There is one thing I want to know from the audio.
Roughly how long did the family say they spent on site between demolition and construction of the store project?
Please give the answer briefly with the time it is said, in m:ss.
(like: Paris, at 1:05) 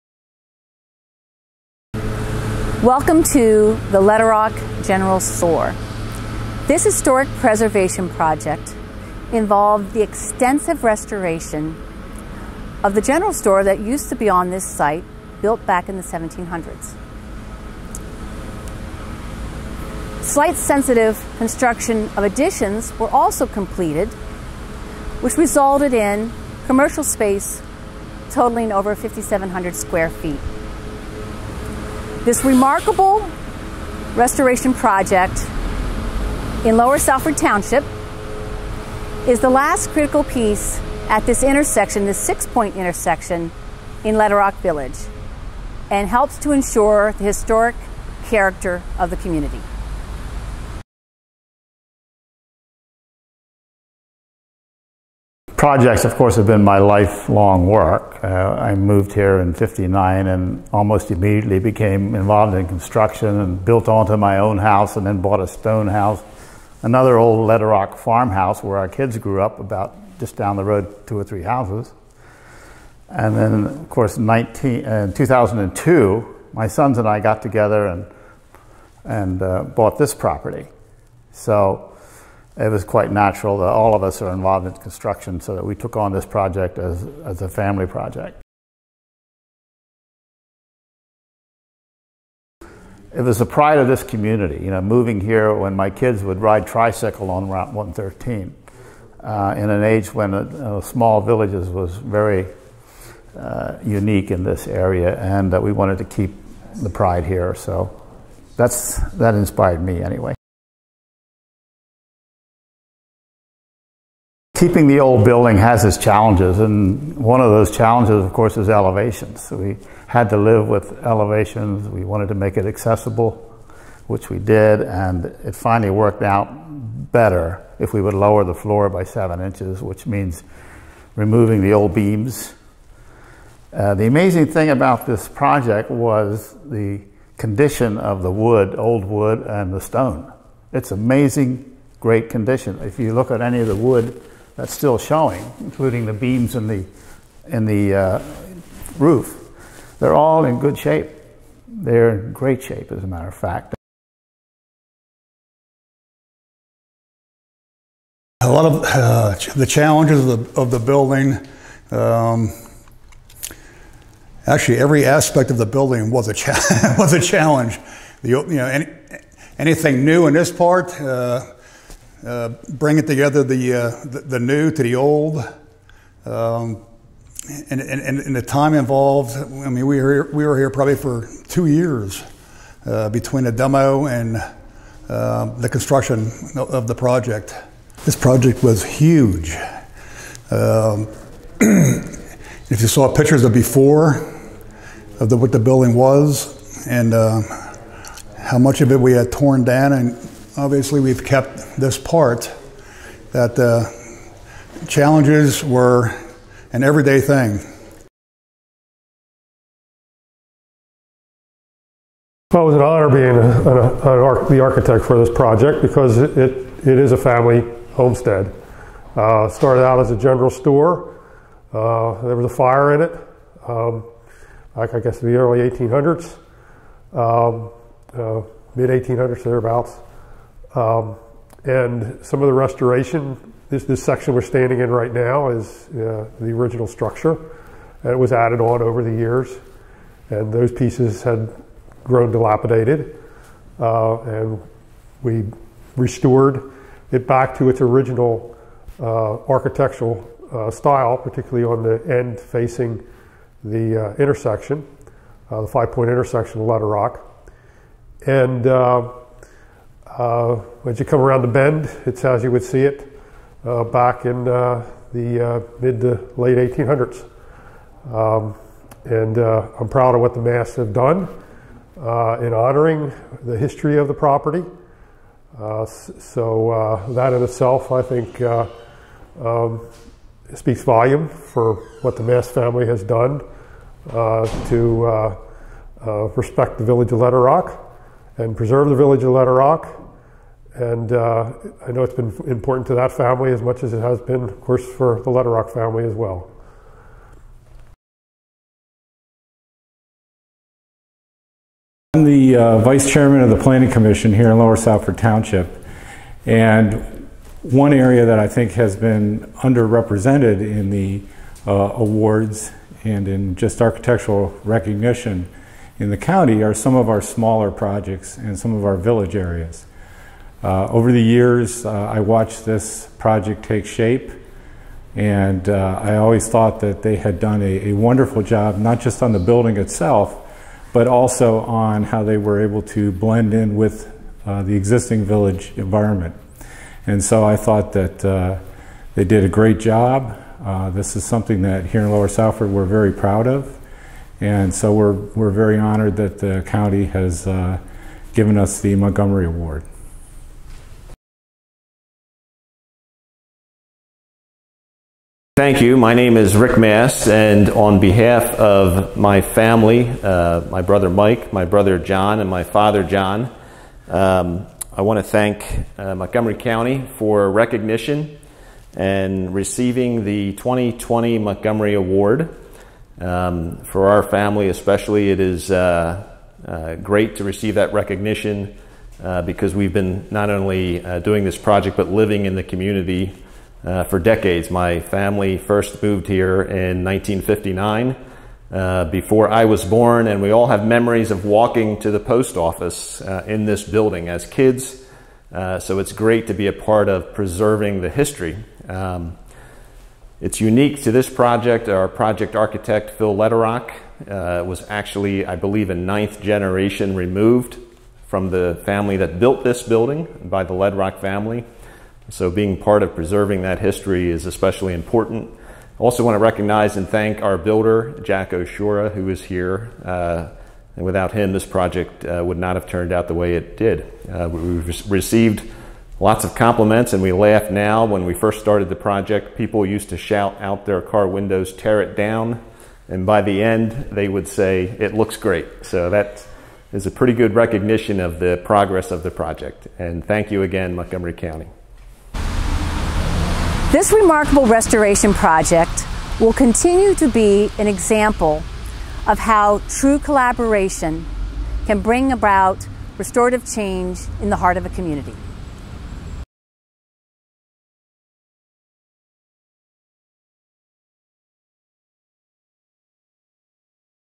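2 years, at 3:01.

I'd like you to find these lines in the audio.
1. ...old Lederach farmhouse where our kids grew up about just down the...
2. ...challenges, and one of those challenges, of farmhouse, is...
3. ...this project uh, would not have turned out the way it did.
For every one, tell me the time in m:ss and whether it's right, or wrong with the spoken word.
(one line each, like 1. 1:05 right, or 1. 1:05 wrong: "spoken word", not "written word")
1. 1:07 right
2. 1:55 wrong: "course", not "farmhouse"
3. 7:01 right.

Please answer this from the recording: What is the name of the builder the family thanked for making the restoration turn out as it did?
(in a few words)
Jack Oshura.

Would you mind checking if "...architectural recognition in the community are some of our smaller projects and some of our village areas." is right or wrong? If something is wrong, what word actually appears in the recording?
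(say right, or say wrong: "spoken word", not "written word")
wrong: "county", not "community".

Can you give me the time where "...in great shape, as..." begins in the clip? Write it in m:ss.
2:32.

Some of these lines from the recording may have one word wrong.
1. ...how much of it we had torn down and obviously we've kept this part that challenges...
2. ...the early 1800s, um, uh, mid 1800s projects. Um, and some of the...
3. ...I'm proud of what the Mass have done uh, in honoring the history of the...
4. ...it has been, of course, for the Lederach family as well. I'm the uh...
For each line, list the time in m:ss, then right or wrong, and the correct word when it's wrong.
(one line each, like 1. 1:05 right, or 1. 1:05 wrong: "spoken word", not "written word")
1. 3:18 right
2. 3:45 wrong: "thereabouts", not "projects"
3. 4:29 right
4. 4:53 right.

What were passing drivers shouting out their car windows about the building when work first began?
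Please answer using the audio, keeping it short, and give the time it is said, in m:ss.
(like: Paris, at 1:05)
tear it down, at 7:11.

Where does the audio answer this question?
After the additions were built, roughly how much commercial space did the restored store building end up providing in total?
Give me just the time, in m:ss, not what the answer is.
0:28.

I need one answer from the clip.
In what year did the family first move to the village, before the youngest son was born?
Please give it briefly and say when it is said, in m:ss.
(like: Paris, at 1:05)
1959, at 6:27.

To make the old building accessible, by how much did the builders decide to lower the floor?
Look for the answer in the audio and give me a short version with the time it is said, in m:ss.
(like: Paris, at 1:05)
7 inches, at 2:09.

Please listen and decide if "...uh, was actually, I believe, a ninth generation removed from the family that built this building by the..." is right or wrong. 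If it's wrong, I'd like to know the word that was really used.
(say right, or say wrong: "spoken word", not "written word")
right.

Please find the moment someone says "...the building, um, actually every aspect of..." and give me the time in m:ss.
2:40.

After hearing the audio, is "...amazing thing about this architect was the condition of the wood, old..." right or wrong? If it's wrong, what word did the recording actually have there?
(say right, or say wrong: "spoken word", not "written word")
wrong: "project", not "architect".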